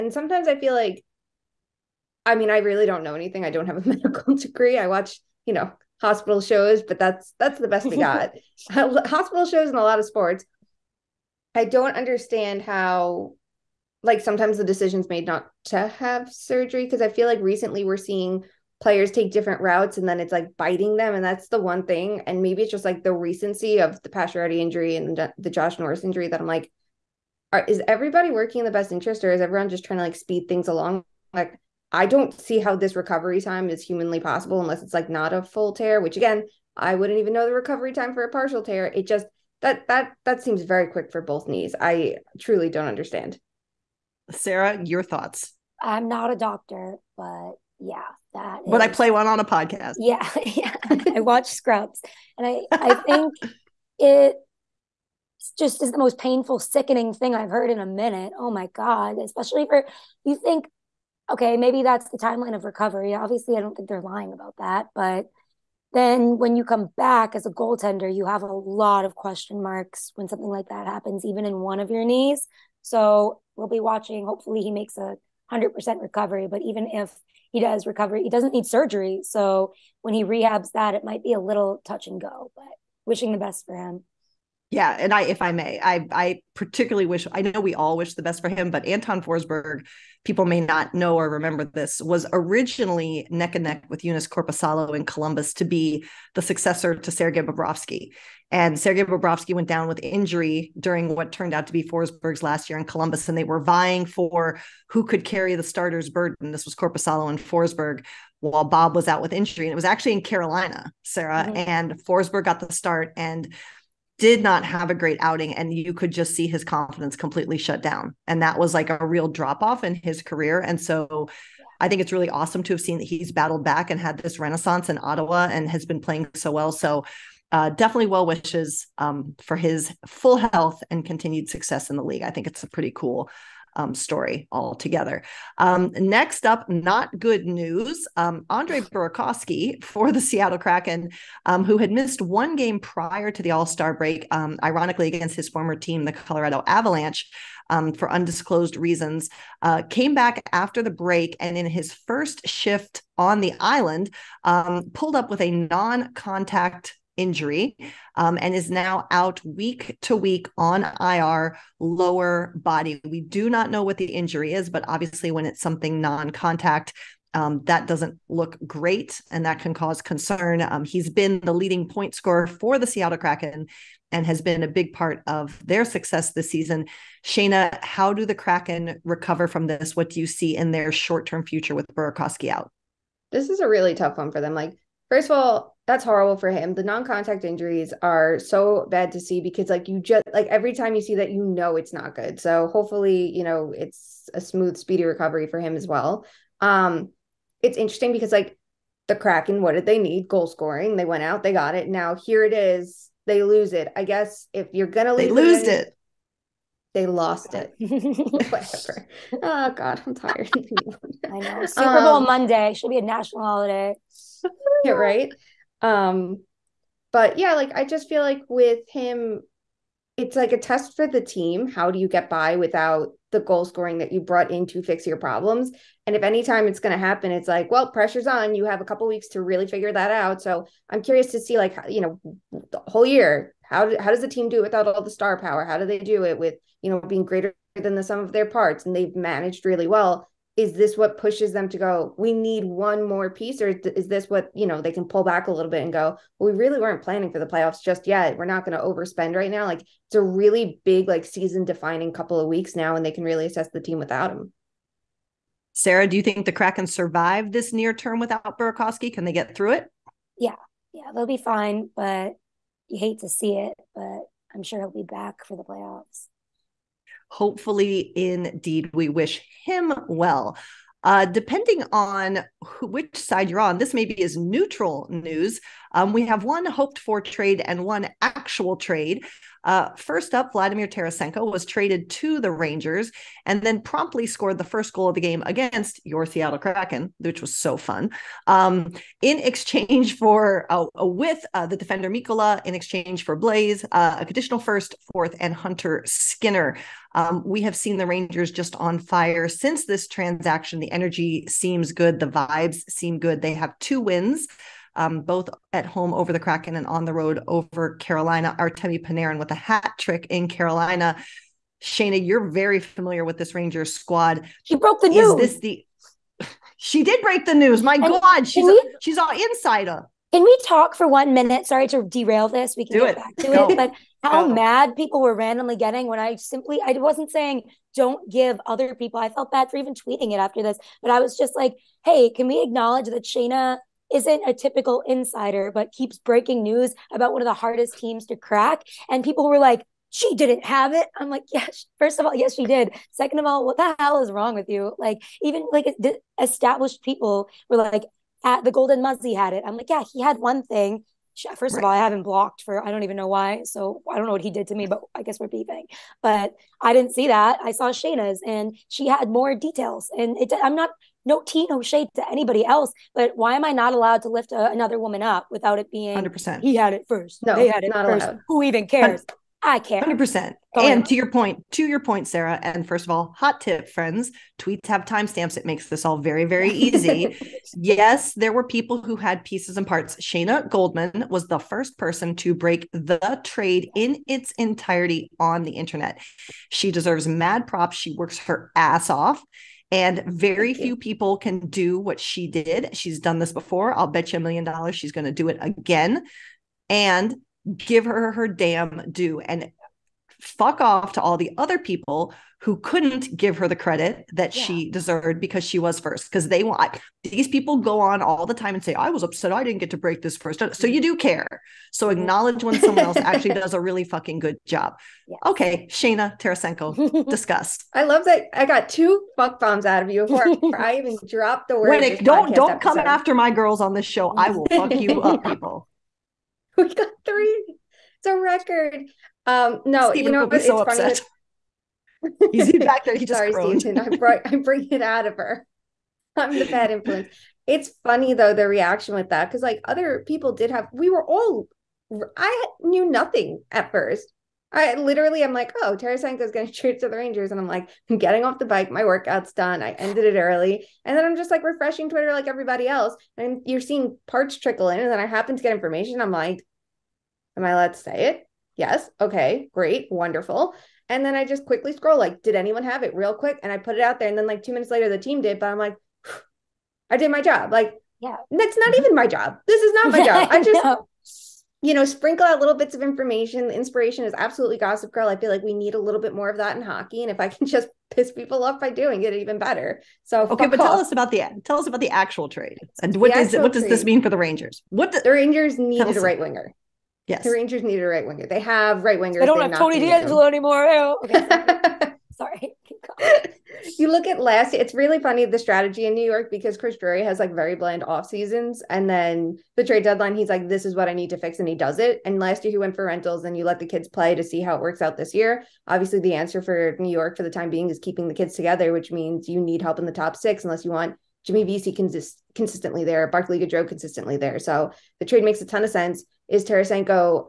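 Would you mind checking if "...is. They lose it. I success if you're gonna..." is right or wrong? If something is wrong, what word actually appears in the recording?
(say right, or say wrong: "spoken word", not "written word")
wrong: "guess", not "success".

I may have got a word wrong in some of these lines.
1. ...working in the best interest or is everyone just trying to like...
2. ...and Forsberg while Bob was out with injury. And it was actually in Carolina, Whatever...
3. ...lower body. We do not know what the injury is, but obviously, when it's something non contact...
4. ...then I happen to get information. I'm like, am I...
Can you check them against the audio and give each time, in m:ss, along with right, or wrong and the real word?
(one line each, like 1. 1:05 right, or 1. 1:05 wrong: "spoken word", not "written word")
1. 0:28 right
2. 1:47 wrong: "Sara", not "Whatever"
3. 2:41 right
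4. 7:35 right.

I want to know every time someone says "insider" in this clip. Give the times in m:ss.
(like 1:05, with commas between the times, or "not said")
5:19, 5:35.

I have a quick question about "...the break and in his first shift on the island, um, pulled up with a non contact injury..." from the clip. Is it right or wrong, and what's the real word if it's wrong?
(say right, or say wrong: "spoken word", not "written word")
right.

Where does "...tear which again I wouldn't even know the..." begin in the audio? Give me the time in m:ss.
0:35.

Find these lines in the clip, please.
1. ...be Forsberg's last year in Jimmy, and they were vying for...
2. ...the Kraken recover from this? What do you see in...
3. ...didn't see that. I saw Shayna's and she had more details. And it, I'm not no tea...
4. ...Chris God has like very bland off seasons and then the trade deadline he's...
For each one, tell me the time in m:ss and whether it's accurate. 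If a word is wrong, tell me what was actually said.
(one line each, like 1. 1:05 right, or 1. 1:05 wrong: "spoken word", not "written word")
1. 1:41 wrong: "Columbus", not "Jimmy"
2. 2:58 right
3. 5:56 right
4. 8:16 wrong: "Drury", not "God".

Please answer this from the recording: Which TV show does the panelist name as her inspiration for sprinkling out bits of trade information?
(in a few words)
Gossip Girl.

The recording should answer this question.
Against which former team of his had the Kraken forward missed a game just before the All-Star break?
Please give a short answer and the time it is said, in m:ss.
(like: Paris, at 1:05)
Colorado Avalanche, at 2:26.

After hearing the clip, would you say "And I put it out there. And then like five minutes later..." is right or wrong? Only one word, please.
wrong.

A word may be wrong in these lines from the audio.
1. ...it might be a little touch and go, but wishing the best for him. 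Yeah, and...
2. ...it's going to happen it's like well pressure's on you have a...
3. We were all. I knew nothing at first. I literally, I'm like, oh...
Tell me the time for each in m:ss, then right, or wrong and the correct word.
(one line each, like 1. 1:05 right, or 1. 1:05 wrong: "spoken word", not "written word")
1. 1:20 right
2. 3:46 right
3. 7:20 right.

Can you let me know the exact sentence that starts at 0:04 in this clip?
I watch, you know, hospital shows, but that's that's the best we got.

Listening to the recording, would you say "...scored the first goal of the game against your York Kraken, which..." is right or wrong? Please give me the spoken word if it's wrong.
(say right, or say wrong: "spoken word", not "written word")
wrong: "Seattle", not "York".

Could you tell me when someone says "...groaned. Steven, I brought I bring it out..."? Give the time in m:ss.
7:13.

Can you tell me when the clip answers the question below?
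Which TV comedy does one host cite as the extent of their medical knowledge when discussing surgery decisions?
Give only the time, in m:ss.
0:51.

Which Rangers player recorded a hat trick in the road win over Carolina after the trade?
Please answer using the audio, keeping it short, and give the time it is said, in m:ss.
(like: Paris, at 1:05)
Artemi Panarin, at 5:08.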